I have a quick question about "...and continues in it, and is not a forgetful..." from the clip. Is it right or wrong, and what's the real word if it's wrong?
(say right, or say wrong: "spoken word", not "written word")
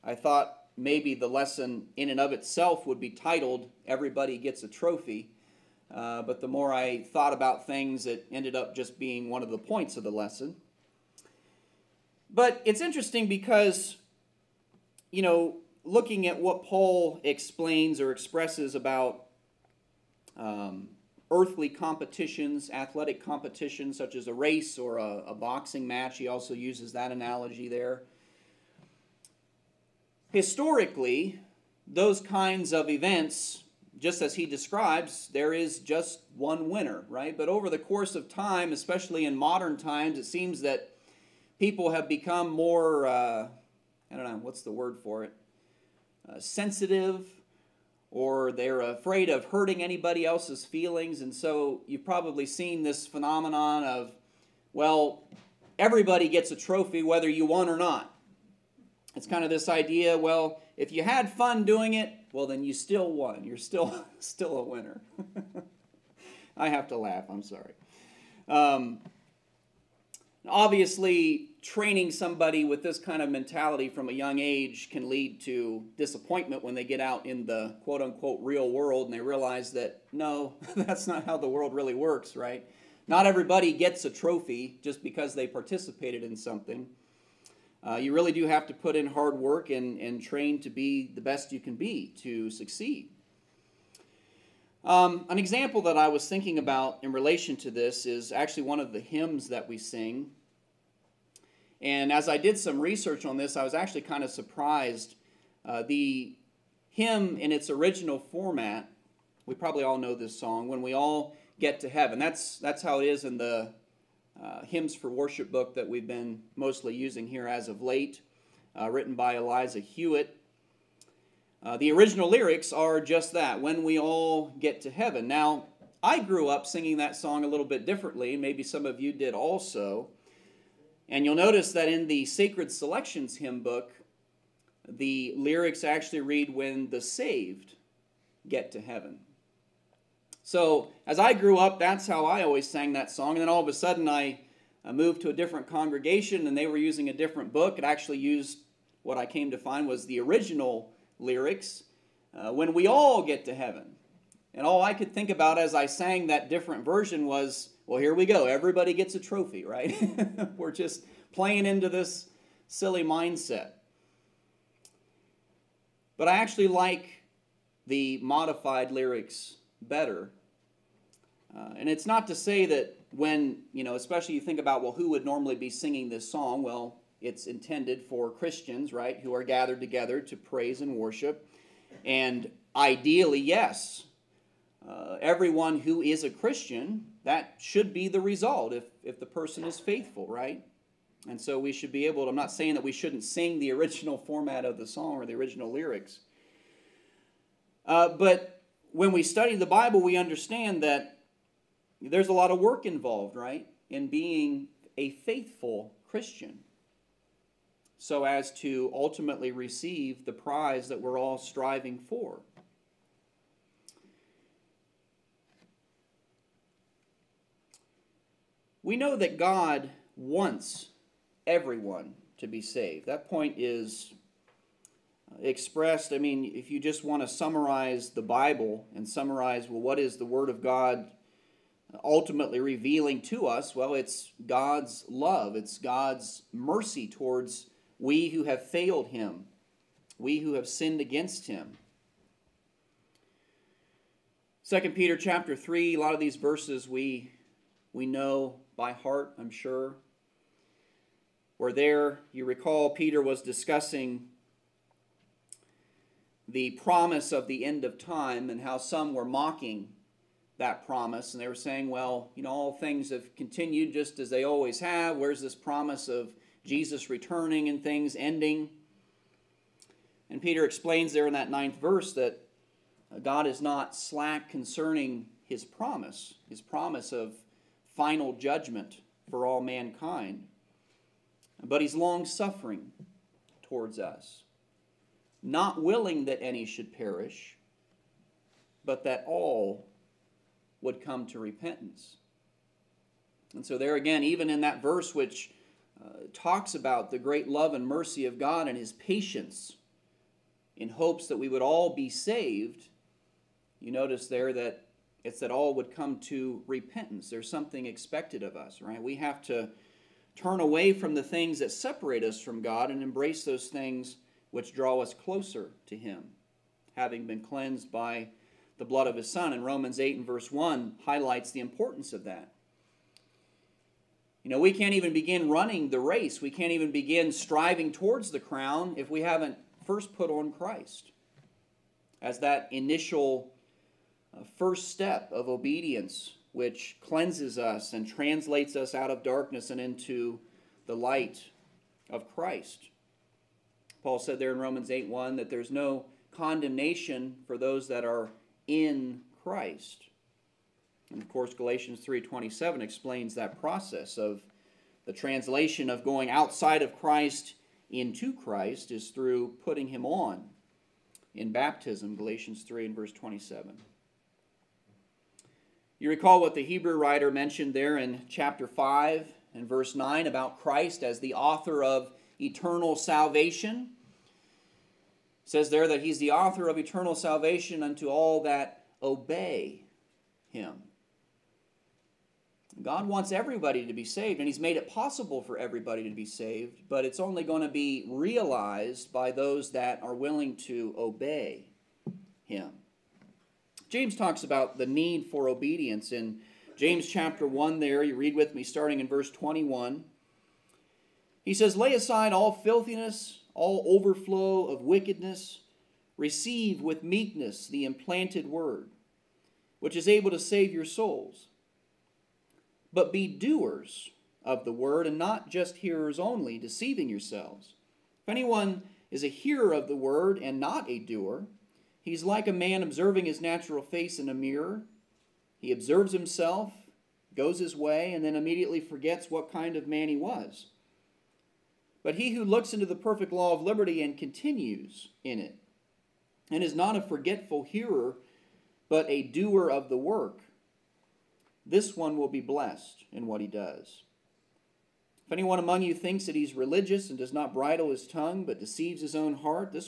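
right.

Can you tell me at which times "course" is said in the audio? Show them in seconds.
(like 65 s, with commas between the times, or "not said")
37 s, 351 s.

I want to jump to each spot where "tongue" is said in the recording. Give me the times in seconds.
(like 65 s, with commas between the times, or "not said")
448 s.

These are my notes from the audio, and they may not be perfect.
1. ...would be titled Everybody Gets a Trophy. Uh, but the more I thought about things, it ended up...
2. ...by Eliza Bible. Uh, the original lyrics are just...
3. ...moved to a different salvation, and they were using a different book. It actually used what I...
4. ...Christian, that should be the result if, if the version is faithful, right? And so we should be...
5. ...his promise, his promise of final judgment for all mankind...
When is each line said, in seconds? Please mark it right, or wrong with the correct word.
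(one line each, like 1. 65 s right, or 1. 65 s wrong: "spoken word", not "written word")
1. 2 s right
2. 119 s wrong: "Hewitt", not "Bible"
3. 144 s wrong: "congregation", not "salvation"
4. 186 s wrong: "person", not "version"
5. 275 s right.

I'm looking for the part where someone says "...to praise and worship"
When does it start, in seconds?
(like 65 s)
180 s.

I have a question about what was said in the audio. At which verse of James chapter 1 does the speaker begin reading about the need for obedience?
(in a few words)
21.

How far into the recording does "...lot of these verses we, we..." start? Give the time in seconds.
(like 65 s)
246 s.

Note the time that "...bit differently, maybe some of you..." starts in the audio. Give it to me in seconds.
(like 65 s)
127 s.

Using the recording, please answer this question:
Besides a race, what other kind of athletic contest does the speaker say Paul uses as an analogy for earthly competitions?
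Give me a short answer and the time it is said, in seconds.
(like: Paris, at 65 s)
A boxing match, at 25 s.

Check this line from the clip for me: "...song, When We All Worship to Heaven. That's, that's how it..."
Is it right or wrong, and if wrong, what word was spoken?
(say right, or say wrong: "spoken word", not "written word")
wrong: "Get", not "Worship".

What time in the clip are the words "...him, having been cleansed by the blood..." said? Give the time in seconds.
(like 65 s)
315 s.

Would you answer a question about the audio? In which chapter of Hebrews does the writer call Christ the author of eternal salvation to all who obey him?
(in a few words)
Chapter 5.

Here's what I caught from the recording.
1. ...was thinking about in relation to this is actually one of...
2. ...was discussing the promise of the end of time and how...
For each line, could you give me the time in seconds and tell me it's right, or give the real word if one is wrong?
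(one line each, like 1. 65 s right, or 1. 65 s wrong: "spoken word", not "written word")
1. 96 s right
2. 253 s right.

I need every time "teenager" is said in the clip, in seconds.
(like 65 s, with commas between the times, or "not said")
not said.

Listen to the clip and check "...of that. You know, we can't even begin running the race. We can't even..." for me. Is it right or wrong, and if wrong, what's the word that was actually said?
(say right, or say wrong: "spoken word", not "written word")
right.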